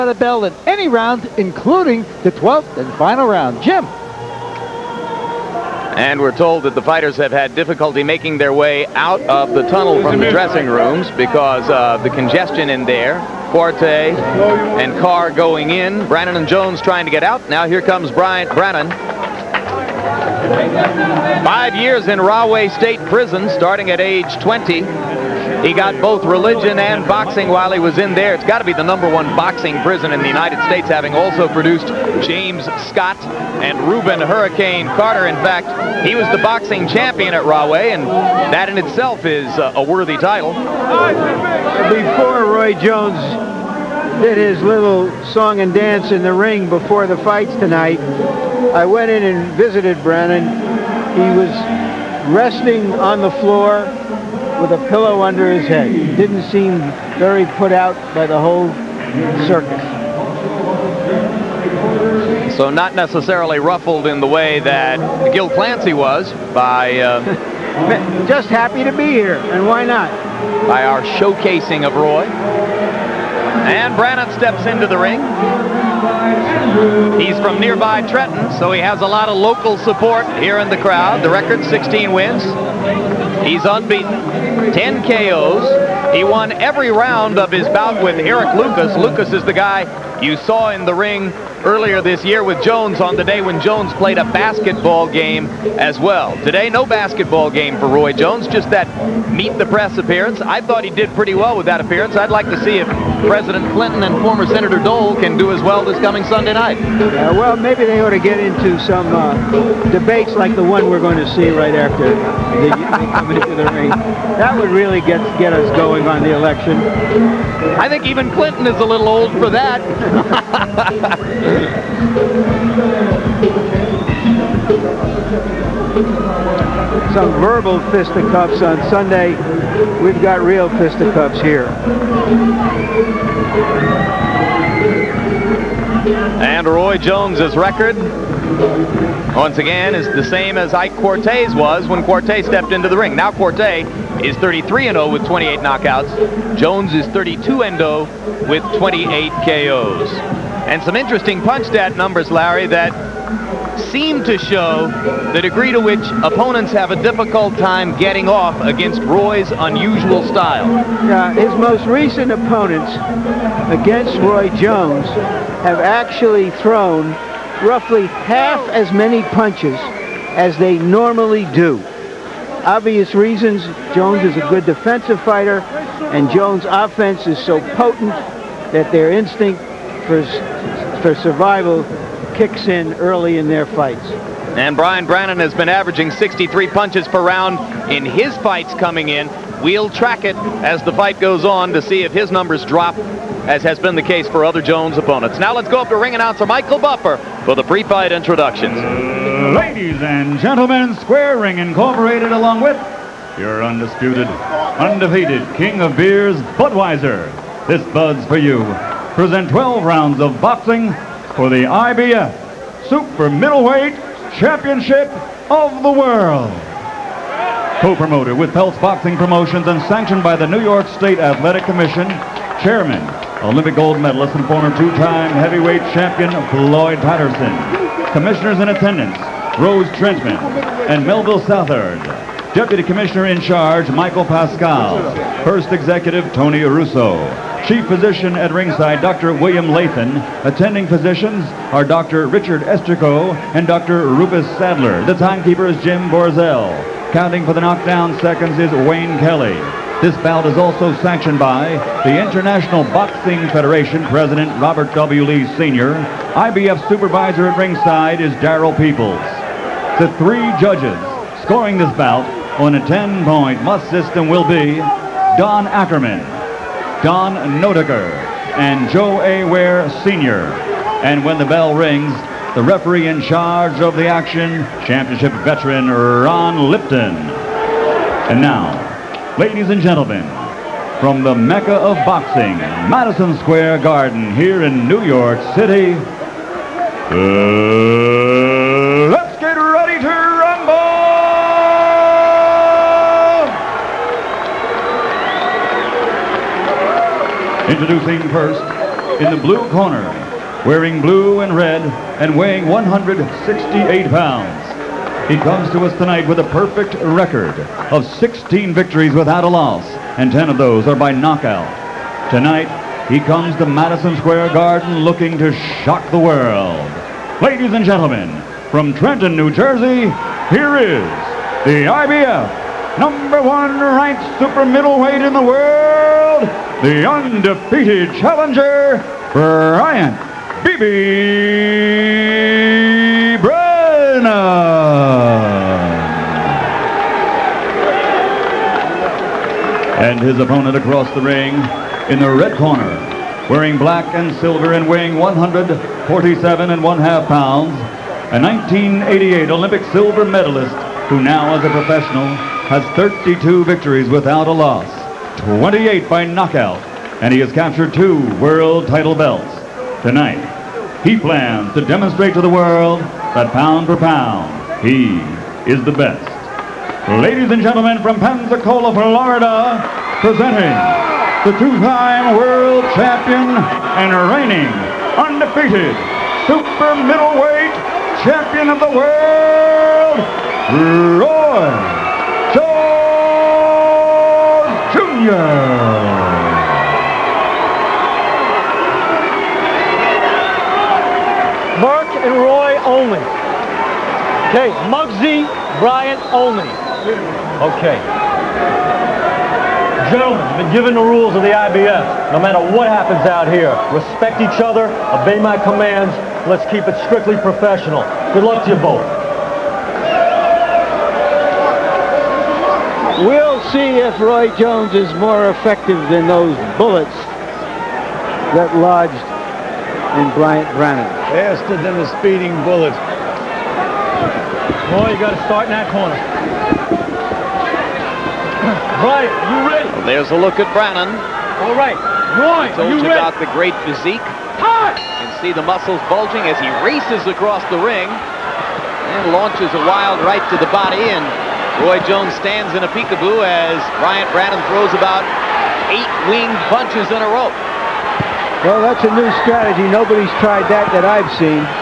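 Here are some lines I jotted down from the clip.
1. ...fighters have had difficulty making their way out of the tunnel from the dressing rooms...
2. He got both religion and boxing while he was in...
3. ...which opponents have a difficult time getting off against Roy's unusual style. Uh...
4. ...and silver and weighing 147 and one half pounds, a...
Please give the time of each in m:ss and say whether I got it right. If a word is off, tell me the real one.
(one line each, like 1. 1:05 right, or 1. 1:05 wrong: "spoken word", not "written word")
1. 0:06 right
2. 0:25 right
3. 2:35 right
4. 5:44 right.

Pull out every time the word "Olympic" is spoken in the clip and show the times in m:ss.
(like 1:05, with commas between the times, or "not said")
3:43, 5:49.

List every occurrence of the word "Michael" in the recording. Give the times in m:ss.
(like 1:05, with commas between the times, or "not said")
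3:16, 3:53.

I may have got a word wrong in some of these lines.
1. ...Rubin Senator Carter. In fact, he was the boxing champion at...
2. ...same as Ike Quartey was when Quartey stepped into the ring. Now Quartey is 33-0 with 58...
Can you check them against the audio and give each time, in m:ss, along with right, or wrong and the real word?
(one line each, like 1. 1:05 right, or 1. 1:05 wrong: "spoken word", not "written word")
1. 0:33 wrong: "Hurricane", not "Senator"
2. 2:20 wrong: "28", not "58".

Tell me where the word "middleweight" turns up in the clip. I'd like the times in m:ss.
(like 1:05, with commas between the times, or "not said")
3:33, 5:24, 6:16.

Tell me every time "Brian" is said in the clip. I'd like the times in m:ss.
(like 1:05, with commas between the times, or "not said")
3:04, 5:29.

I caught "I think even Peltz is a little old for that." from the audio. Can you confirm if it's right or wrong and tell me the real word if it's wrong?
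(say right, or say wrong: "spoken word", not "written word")
wrong: "Clinton", not "Peltz".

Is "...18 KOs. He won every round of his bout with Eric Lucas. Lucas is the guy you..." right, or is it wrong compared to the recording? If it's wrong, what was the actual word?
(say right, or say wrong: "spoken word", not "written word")
wrong: "10", not "18".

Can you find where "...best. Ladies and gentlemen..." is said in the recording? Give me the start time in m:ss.
6:05.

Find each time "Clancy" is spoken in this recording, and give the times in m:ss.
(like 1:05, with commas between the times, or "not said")
1:05.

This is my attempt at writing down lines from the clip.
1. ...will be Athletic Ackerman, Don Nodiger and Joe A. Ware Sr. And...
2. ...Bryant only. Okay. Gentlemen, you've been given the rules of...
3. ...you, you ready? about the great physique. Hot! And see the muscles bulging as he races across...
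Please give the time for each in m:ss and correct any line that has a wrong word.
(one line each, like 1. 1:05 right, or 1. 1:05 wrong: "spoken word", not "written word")
1. 4:24 wrong: "Don", not "Athletic"
2. 6:35 right
3. 7:12 right.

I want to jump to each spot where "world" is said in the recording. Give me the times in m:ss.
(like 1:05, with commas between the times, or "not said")
3:35, 5:16, 5:25, 5:58, 6:02, 6:12, 6:21.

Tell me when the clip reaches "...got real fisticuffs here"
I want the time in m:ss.
2:10.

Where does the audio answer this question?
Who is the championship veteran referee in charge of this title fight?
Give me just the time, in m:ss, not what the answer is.
4:35.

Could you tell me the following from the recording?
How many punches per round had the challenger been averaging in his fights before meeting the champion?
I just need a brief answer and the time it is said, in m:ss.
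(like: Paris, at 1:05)
63, at 3:06.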